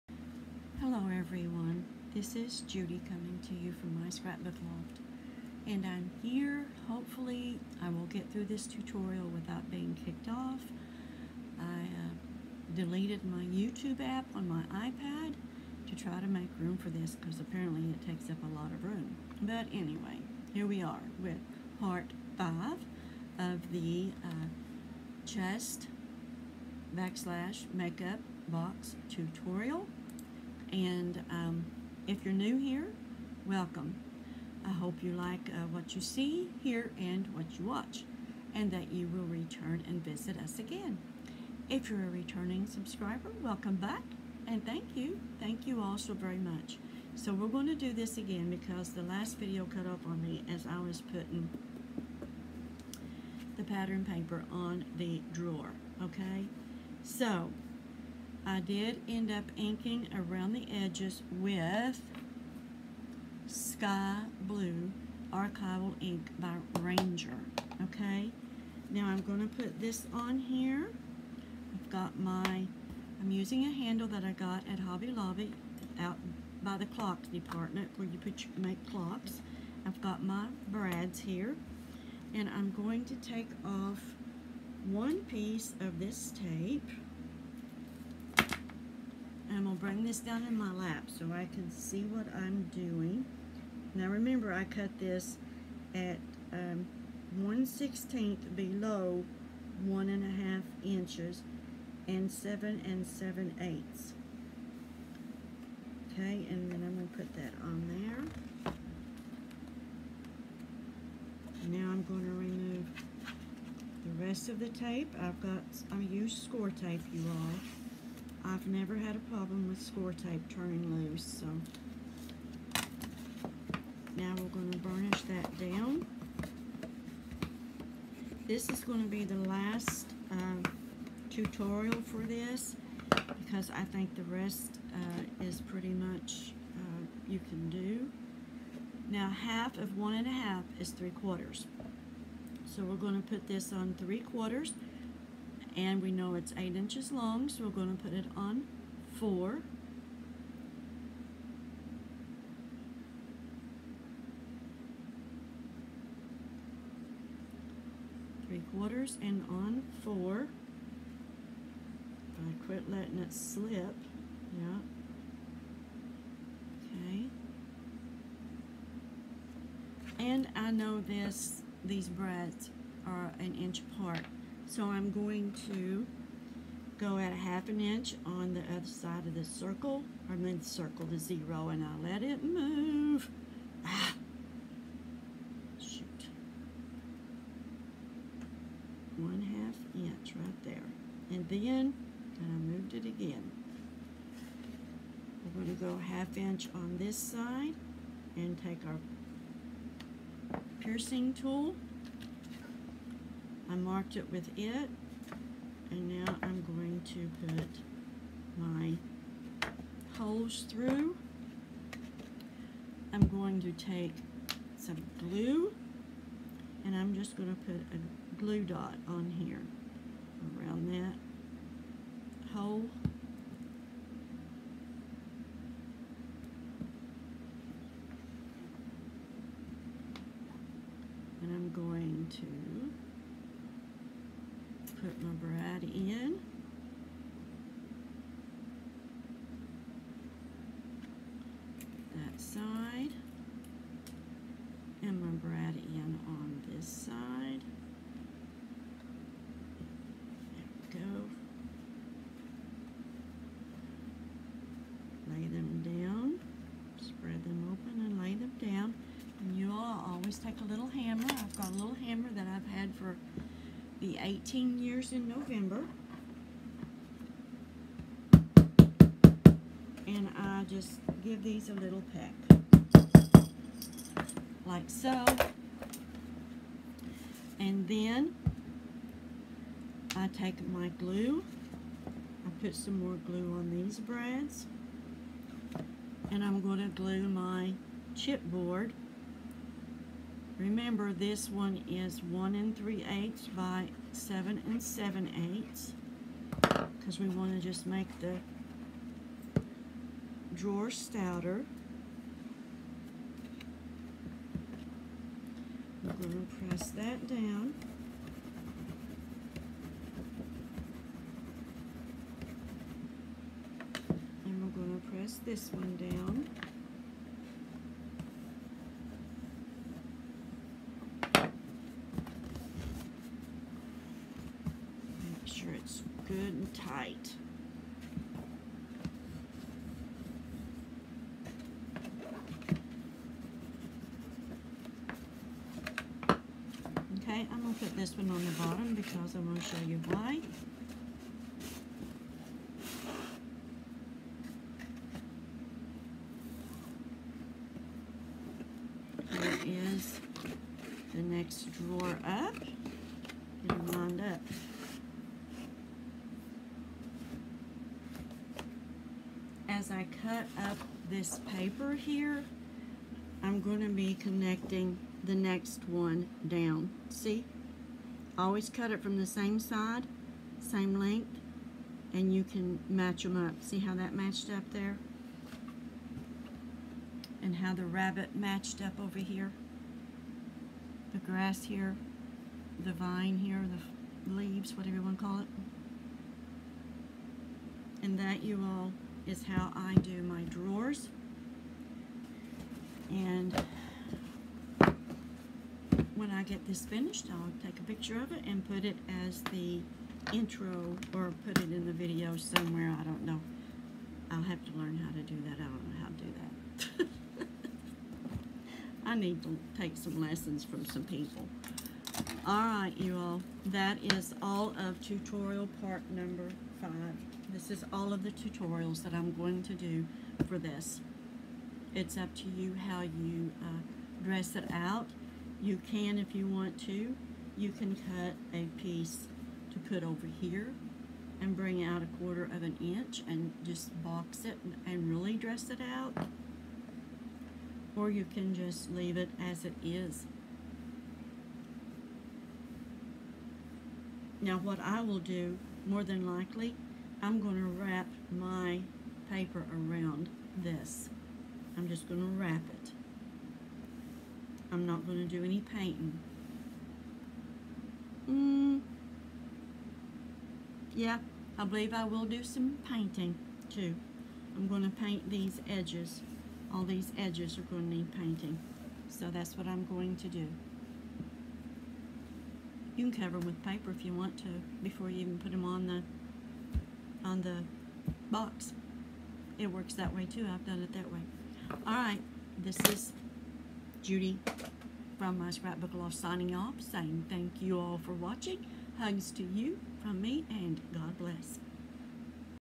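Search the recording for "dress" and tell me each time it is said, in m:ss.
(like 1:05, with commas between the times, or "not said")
7:04, 7:15.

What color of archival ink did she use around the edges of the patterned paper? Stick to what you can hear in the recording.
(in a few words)
Sky Blue.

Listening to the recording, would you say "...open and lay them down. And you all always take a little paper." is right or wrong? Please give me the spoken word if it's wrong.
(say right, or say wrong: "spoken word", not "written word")
wrong: "hammer", not "paper".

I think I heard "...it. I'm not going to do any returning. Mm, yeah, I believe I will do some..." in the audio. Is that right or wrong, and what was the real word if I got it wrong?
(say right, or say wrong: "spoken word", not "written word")
wrong: "painting", not "returning".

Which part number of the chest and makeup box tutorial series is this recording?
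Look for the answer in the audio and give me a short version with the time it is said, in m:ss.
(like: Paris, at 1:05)
5, at 0:21.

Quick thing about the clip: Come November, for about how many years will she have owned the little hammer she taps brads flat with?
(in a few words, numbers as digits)
18.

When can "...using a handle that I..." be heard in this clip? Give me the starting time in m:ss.
1:13.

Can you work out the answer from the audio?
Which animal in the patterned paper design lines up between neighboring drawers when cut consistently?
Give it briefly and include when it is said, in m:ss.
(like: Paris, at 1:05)
Rabbit, at 6:17.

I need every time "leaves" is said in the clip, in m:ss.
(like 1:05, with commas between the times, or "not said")
6:24, 7:18.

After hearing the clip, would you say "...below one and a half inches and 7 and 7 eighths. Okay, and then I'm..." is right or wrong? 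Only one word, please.
right.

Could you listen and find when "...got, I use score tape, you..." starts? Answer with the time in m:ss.
1:55.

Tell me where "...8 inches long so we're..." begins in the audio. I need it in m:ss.
2:26.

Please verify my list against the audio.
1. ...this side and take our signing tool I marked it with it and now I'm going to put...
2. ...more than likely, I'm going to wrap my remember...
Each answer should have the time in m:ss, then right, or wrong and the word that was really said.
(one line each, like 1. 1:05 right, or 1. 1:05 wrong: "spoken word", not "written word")
1. 3:16 wrong: "piercing", not "signing"
2. 7:25 wrong: "paper", not "remember".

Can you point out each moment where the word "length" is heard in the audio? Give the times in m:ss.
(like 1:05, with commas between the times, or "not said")
6:10.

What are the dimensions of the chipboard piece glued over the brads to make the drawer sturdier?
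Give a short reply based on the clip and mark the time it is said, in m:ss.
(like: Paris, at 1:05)
1 3/8 by 7 7/8, at 4:52.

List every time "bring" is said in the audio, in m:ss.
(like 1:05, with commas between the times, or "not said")
1:29, 7:11.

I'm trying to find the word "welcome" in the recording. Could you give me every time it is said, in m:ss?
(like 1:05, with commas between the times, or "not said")
0:33, 0:43.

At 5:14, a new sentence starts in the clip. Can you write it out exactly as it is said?
And we're going to press this one down.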